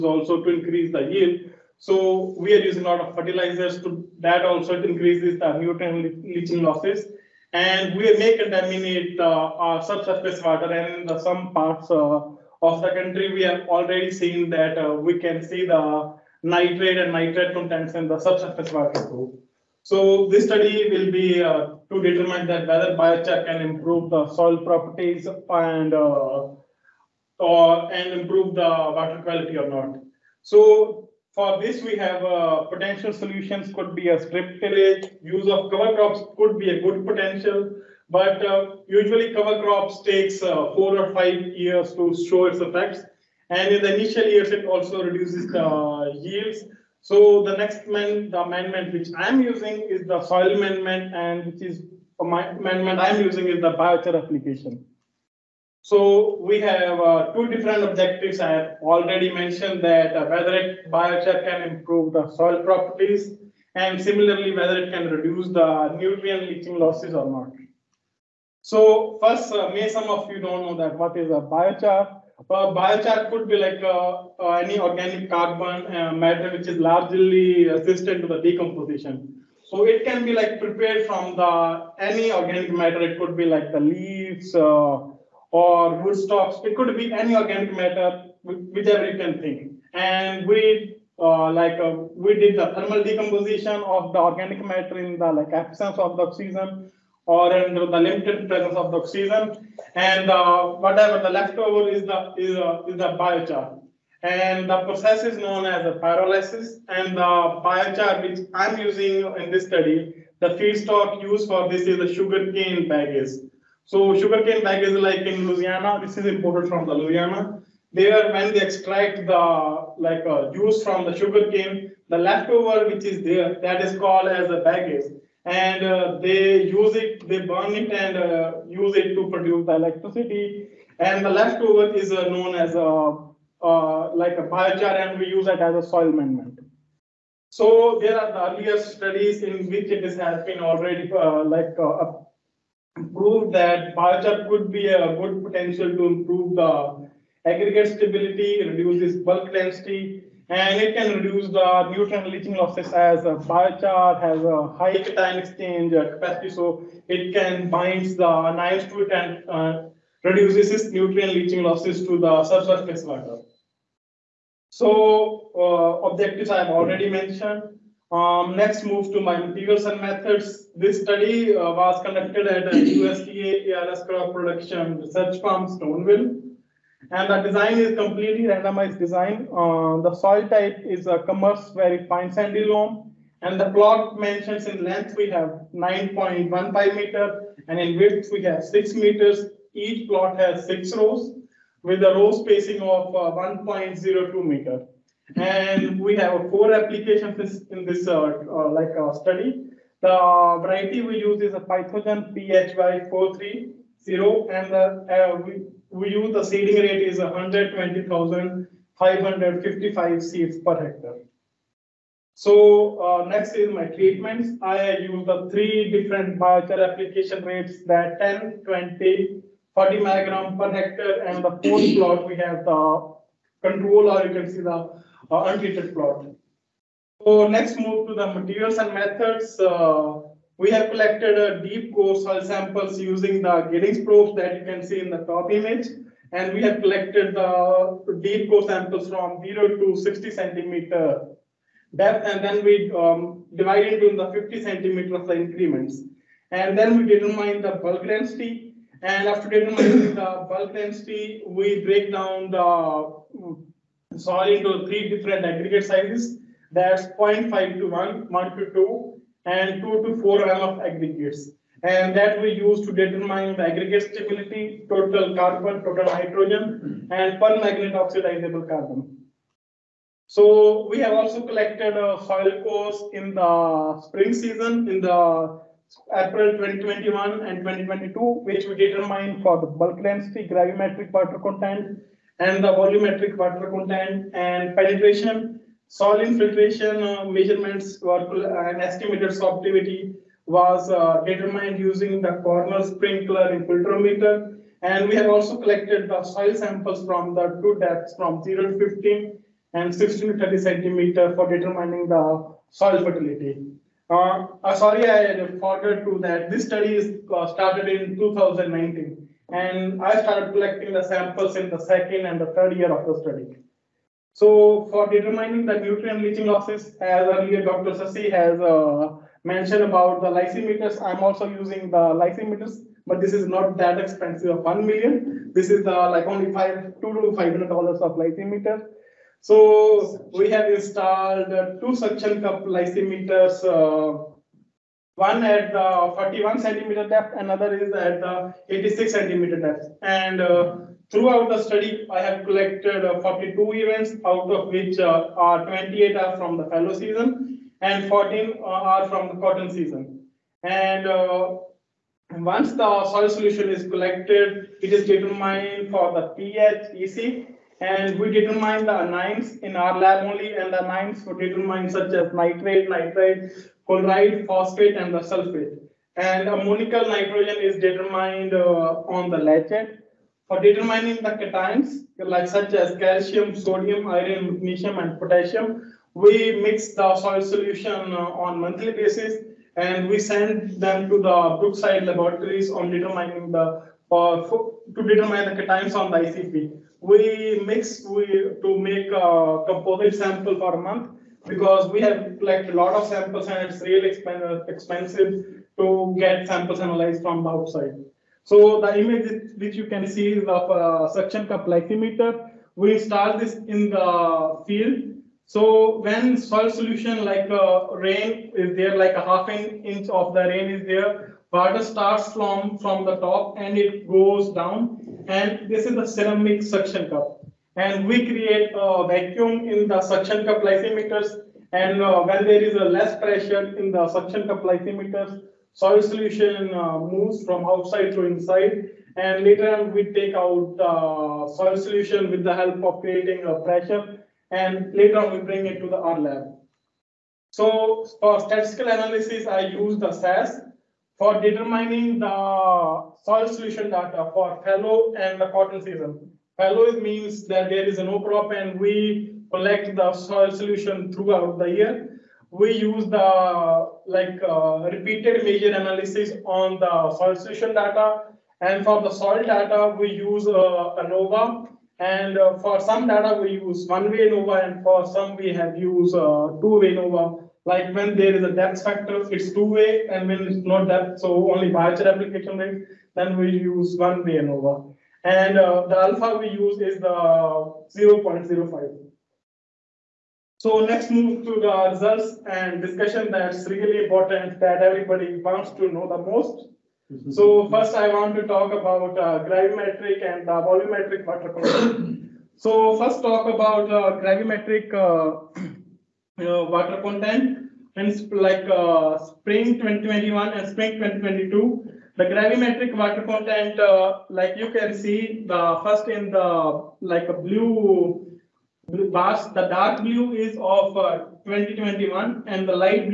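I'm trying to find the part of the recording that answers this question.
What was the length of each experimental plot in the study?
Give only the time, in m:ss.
3:05.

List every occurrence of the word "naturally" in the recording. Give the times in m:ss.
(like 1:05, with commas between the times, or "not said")
not said.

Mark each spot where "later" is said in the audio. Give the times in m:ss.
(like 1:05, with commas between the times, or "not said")
6:09, 7:09, 7:14.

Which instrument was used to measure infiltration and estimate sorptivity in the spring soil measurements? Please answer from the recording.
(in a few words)
Cornell sprinkler infiltrometer.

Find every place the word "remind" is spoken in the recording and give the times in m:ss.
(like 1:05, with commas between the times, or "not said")
not said.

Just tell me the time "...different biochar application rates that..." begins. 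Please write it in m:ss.
3:35.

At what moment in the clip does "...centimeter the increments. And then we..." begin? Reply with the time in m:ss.
4:04.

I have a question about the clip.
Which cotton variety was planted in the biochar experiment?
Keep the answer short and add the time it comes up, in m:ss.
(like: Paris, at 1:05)
PhytoGen PHY430, at 3:21.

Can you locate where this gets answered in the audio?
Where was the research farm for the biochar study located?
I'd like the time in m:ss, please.
2:55.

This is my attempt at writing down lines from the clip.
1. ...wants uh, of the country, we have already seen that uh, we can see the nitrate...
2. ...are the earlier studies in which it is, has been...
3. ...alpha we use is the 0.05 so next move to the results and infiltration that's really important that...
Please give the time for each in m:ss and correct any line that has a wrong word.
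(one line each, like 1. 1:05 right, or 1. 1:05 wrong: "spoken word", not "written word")
1. 0:11 wrong: "parts", not "wants"
2. 2:18 right
3. 7:55 wrong: "discussion", not "infiltration".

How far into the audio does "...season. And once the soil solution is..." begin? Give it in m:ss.
5:49.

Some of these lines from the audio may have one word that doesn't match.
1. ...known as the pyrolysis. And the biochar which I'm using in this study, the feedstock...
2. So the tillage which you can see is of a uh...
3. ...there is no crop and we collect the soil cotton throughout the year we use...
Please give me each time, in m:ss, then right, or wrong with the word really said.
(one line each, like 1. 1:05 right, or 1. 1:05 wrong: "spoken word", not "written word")
1. 1:45 right
2. 6:38 wrong: "image", not "tillage"
3. 7:27 wrong: "solution", not "cotton".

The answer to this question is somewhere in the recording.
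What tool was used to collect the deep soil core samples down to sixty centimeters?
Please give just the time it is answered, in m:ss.
3:53.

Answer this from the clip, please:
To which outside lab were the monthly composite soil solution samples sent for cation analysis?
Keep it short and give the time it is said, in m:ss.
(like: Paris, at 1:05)
Brookside laboratories, at 6:21.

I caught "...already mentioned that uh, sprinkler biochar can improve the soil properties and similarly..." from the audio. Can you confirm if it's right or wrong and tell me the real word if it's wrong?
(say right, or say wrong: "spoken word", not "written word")
wrong: "whether", not "sprinkler".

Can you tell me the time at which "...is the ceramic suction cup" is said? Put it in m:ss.
6:55.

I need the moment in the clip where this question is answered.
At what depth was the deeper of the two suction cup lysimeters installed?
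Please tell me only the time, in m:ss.
5:38.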